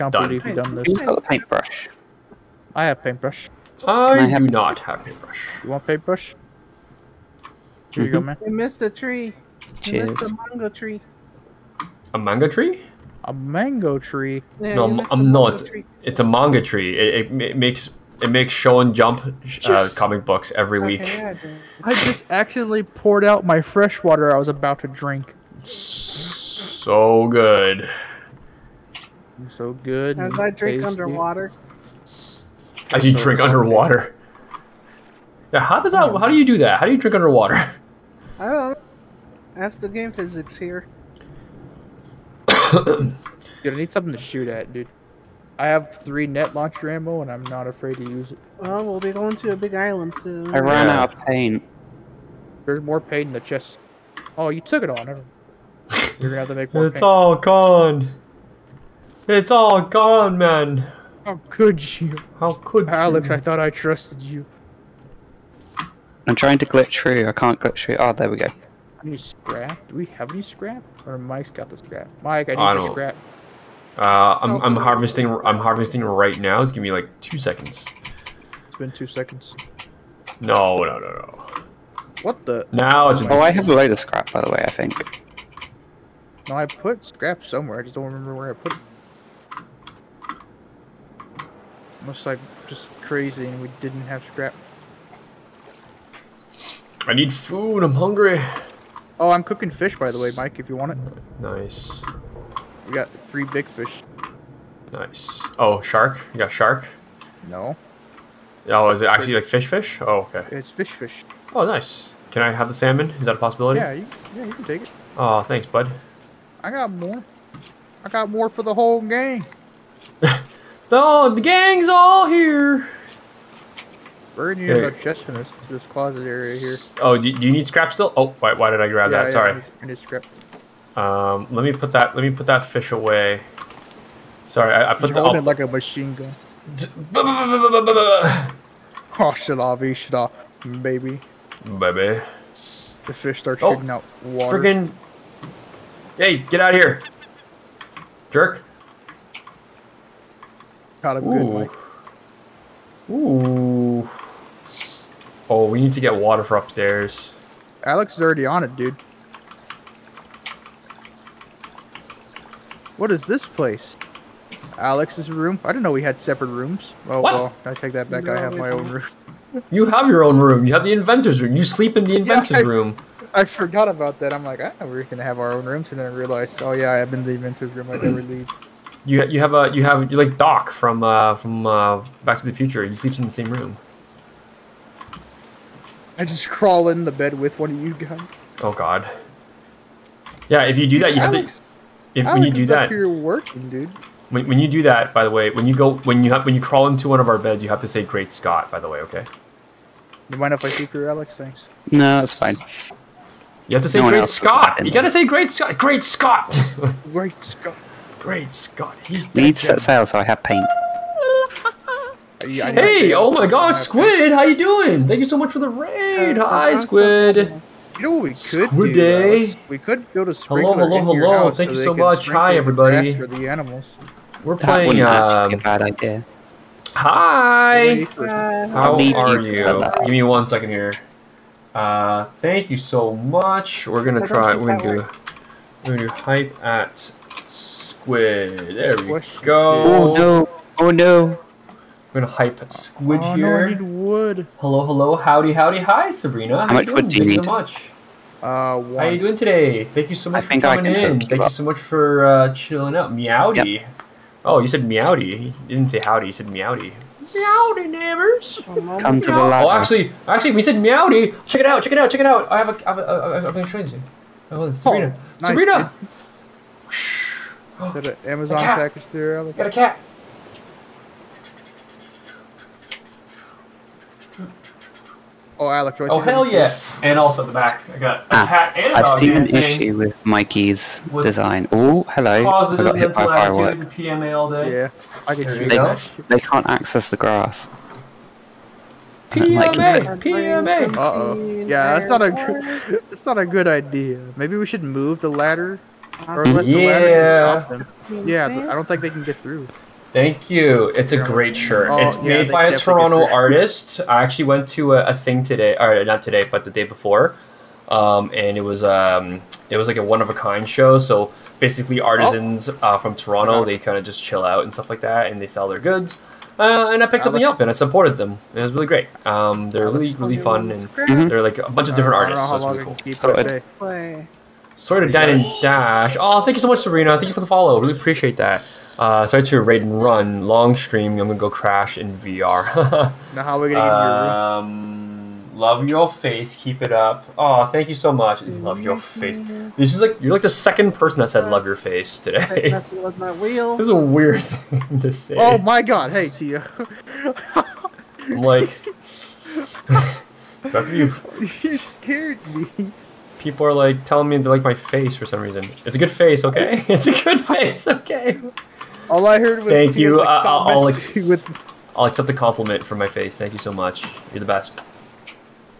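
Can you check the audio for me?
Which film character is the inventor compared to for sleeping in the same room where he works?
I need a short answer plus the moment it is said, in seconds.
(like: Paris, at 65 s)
Doc, at 180 s.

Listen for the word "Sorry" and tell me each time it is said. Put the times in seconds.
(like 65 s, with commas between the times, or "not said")
129 s, 134 s.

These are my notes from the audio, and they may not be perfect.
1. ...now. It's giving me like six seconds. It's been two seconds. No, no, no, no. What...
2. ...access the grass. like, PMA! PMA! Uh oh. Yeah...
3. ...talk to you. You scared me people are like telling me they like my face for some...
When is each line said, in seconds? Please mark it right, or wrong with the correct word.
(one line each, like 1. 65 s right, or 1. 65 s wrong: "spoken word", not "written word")
1. 76 s wrong: "two", not "six"
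2. 286 s right
3. 350 s right.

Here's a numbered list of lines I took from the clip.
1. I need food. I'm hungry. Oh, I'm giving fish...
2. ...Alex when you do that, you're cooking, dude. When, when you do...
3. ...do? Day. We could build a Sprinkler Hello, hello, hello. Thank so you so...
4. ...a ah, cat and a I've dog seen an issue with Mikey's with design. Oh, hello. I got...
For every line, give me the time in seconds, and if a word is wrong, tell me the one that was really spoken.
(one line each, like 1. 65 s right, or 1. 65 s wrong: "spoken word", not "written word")
1. 97 s wrong: "cooking", not "giving"
2. 192 s wrong: "working", not "cooking"
3. 218 s right
4. 278 s right.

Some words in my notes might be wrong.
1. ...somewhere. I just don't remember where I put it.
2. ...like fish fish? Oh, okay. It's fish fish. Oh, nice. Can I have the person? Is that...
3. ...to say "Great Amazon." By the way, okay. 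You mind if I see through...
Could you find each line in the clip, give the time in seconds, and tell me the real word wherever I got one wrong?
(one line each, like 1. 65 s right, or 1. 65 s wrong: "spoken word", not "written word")
1. 87 s right
2. 109 s wrong: "salmon", not "person"
3. 197 s wrong: "Scott", not "Amazon".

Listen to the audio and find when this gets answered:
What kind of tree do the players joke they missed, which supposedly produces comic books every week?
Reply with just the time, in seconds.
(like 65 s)
16 s.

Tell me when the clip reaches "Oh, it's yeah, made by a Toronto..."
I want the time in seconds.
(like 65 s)
301 s.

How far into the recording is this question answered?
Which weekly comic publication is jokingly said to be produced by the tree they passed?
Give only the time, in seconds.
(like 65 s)
18 s.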